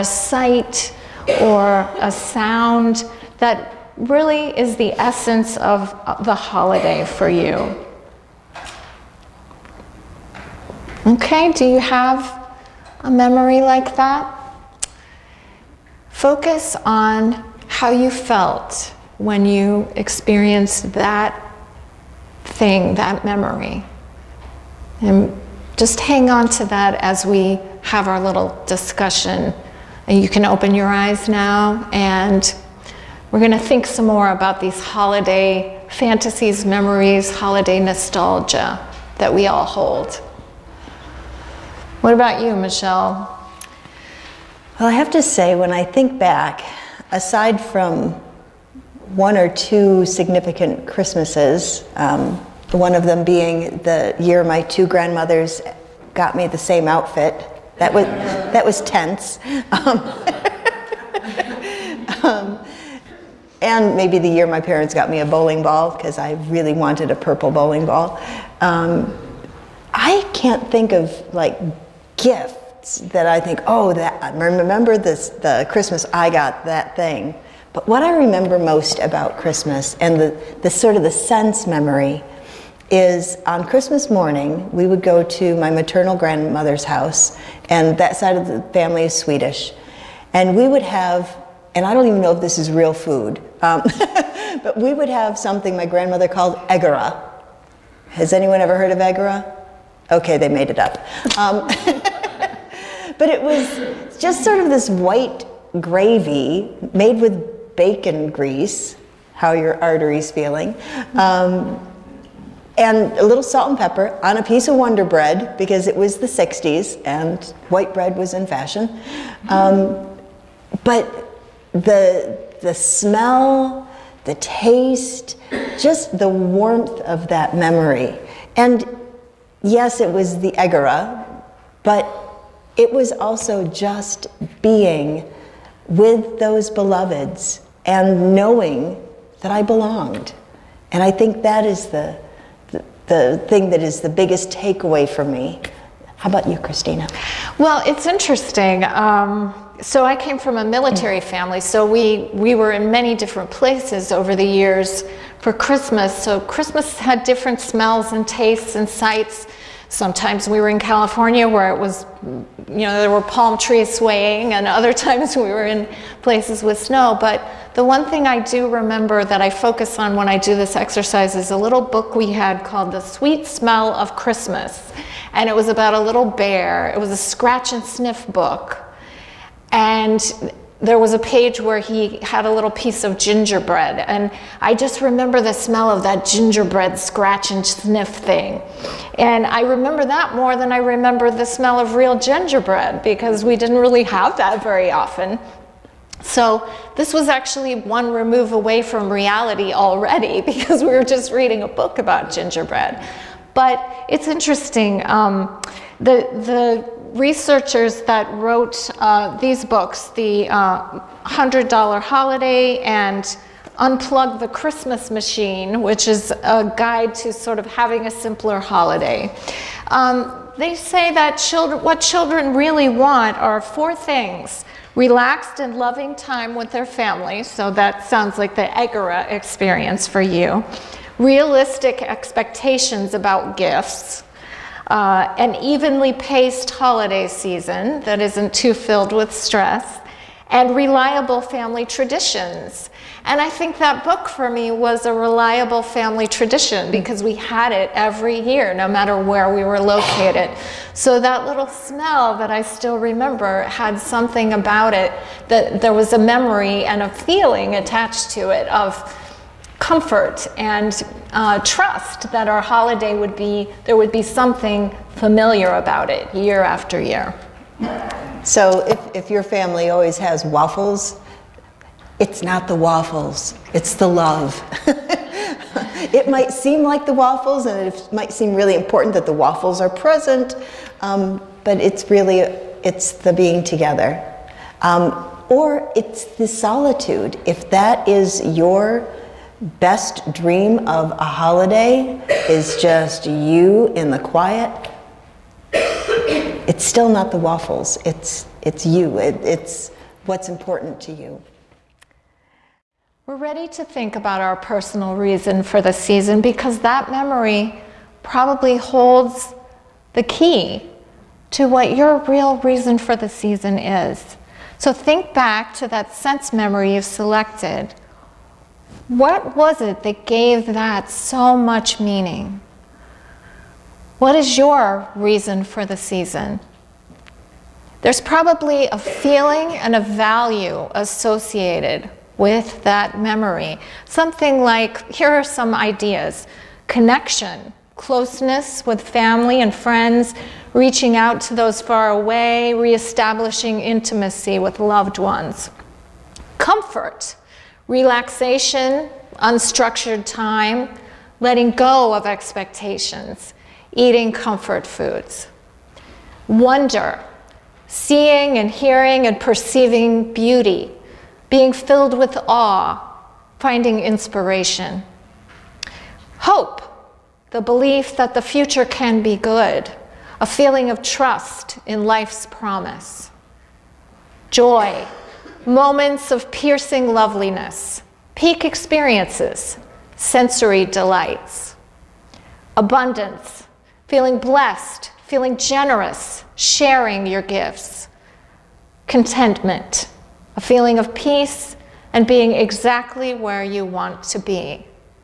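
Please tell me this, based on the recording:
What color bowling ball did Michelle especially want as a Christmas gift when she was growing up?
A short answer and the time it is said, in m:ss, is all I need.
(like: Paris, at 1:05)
Purple, at 1:07.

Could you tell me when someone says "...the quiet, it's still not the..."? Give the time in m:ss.
4:54.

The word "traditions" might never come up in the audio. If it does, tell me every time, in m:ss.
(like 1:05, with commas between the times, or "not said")
4:01, 4:06.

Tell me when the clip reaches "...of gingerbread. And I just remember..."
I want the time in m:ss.
3:03.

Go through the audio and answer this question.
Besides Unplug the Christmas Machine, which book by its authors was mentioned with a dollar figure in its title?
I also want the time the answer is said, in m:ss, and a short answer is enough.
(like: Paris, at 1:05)
$100 Holiday, at 3:31.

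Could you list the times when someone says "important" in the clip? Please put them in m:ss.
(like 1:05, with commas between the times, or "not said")
4:38, 5:00.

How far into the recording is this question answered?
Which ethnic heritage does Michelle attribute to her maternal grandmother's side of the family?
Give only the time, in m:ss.
1:29.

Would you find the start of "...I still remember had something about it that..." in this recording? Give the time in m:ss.
4:12.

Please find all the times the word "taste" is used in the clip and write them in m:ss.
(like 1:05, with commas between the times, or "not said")
2:04, 2:38.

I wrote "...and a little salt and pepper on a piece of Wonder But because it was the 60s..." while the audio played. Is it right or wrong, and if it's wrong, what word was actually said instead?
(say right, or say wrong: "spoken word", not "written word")
wrong: "Bread", not "But".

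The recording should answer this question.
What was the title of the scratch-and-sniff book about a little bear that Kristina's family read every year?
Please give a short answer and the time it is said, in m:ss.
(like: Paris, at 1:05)
The Sweet Smell of Christmas, at 2:52.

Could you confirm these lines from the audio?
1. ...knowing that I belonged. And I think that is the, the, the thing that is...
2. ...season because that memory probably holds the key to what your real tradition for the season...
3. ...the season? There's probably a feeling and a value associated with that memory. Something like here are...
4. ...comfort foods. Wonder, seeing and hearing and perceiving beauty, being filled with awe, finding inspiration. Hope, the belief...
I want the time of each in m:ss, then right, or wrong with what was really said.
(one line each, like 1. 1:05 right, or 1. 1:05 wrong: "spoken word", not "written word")
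1. 2:18 right
2. 5:05 wrong: "reason", not "tradition"
3. 5:25 right
4. 5:54 right.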